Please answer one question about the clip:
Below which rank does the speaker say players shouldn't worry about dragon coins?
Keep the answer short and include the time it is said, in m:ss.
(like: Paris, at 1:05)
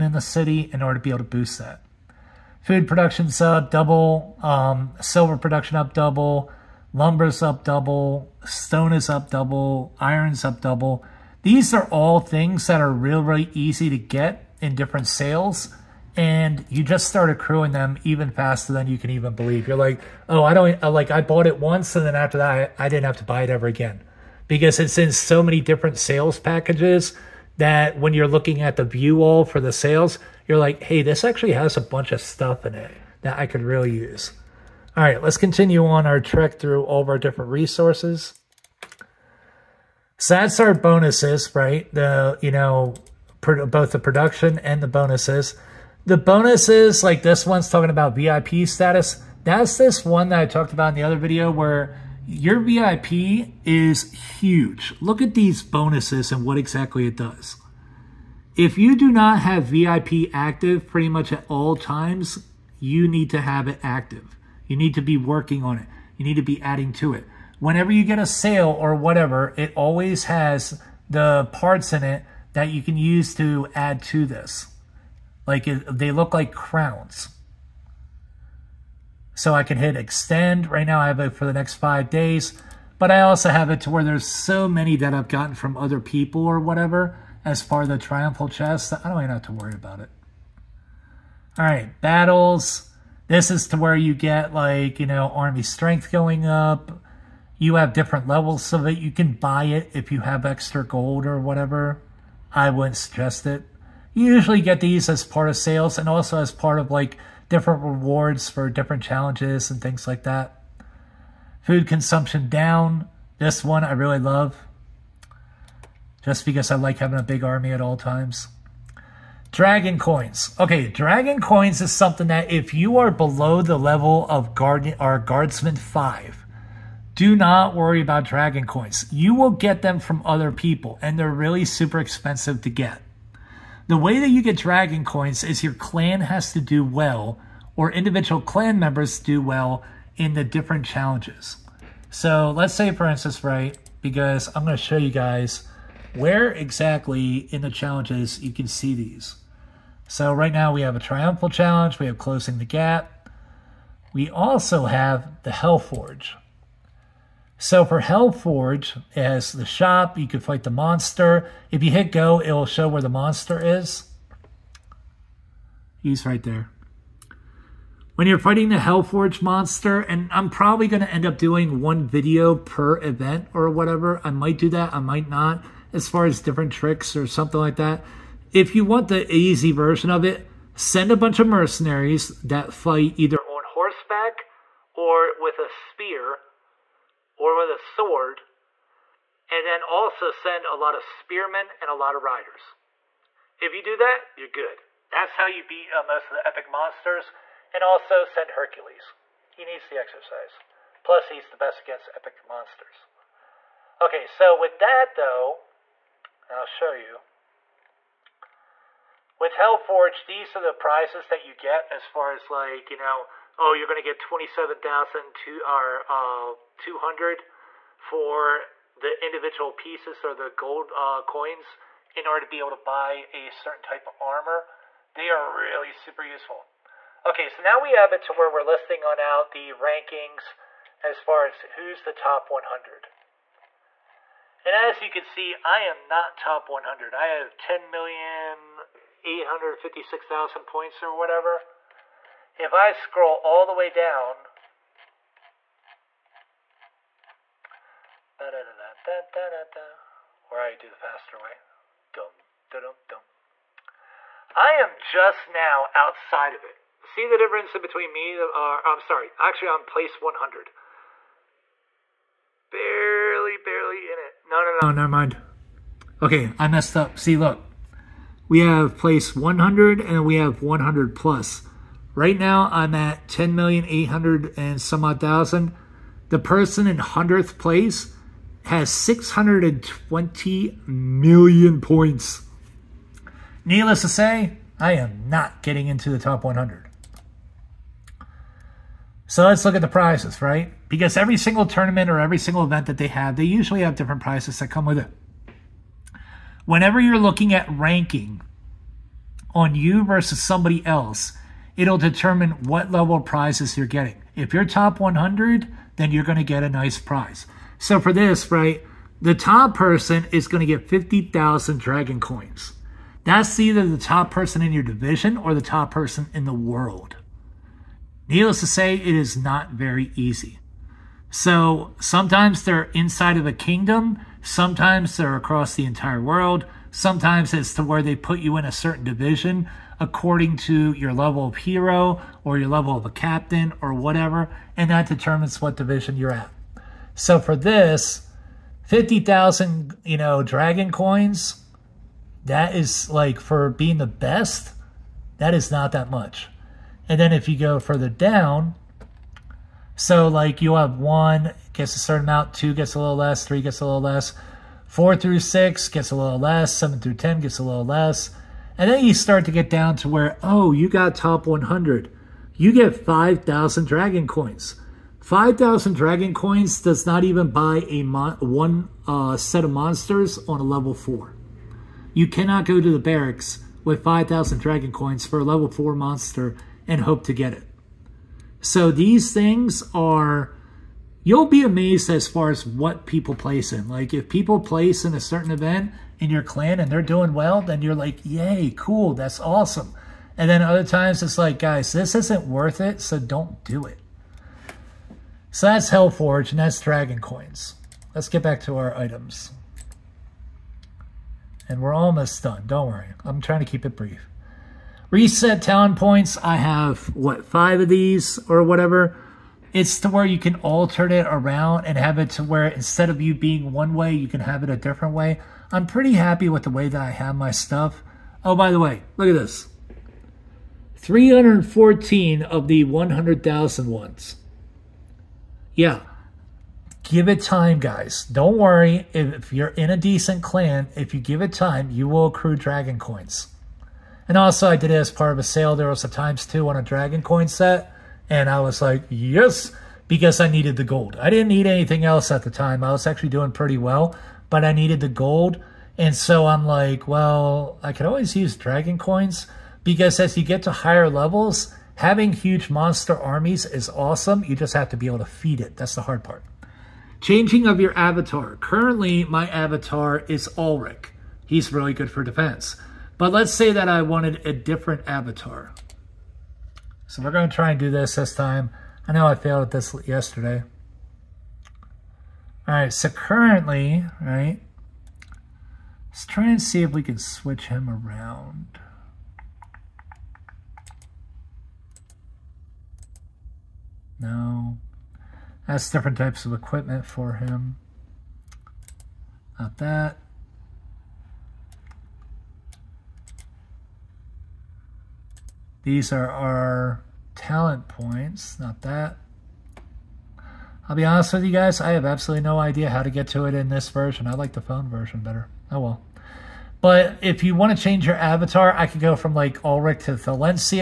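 Guardsman 5, at 2:05.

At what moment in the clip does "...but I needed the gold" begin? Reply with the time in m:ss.
7:24.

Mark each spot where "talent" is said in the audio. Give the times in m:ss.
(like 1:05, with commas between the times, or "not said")
6:45, 8:17.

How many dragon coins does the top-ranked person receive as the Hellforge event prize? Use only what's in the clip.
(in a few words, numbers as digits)
50,000.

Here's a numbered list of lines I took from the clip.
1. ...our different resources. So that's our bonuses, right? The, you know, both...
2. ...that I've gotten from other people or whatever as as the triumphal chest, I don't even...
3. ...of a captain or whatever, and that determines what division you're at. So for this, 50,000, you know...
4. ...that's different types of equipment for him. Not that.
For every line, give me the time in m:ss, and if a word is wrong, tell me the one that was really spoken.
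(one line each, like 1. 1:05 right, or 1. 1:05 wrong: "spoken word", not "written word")
1. 0:37 right
2. 1:24 right
3. 5:32 right
4. 8:05 right.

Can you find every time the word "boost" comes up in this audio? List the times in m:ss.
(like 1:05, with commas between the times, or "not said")
0:01.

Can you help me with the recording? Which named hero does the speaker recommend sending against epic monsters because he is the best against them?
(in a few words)
Hercules.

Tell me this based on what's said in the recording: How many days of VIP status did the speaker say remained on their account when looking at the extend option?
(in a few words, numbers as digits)
5 days.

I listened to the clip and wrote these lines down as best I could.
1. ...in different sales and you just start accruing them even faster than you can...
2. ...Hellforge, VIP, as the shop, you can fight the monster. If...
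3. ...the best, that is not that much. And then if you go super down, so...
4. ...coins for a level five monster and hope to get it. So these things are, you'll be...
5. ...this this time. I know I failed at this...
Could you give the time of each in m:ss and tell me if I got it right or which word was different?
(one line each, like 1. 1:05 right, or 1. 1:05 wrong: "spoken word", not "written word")
1. 0:14 right
2. 2:38 wrong: "Forge", not "VIP"
3. 5:43 wrong: "further", not "super"
4. 6:14 wrong: "four", not "five"
5. 7:47 right.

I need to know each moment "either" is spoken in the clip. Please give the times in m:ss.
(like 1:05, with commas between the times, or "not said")
3:03, 5:13.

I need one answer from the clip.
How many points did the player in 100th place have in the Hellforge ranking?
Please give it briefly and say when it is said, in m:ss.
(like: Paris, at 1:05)
620 million, at 4:38.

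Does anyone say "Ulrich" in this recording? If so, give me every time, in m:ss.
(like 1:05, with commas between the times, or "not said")
7:40, 8:29.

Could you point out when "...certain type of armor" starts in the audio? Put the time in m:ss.
3:43.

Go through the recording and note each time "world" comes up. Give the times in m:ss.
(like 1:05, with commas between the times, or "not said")
5:16, 5:26.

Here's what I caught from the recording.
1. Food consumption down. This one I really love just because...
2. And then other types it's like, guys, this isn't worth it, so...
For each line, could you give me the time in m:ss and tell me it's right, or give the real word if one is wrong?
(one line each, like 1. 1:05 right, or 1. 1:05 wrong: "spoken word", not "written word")
1. 1:51 right
2. 6:30 wrong: "times", not "types".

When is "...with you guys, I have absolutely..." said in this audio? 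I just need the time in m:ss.
8:21.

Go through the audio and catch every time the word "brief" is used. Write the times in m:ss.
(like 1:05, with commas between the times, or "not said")
6:43.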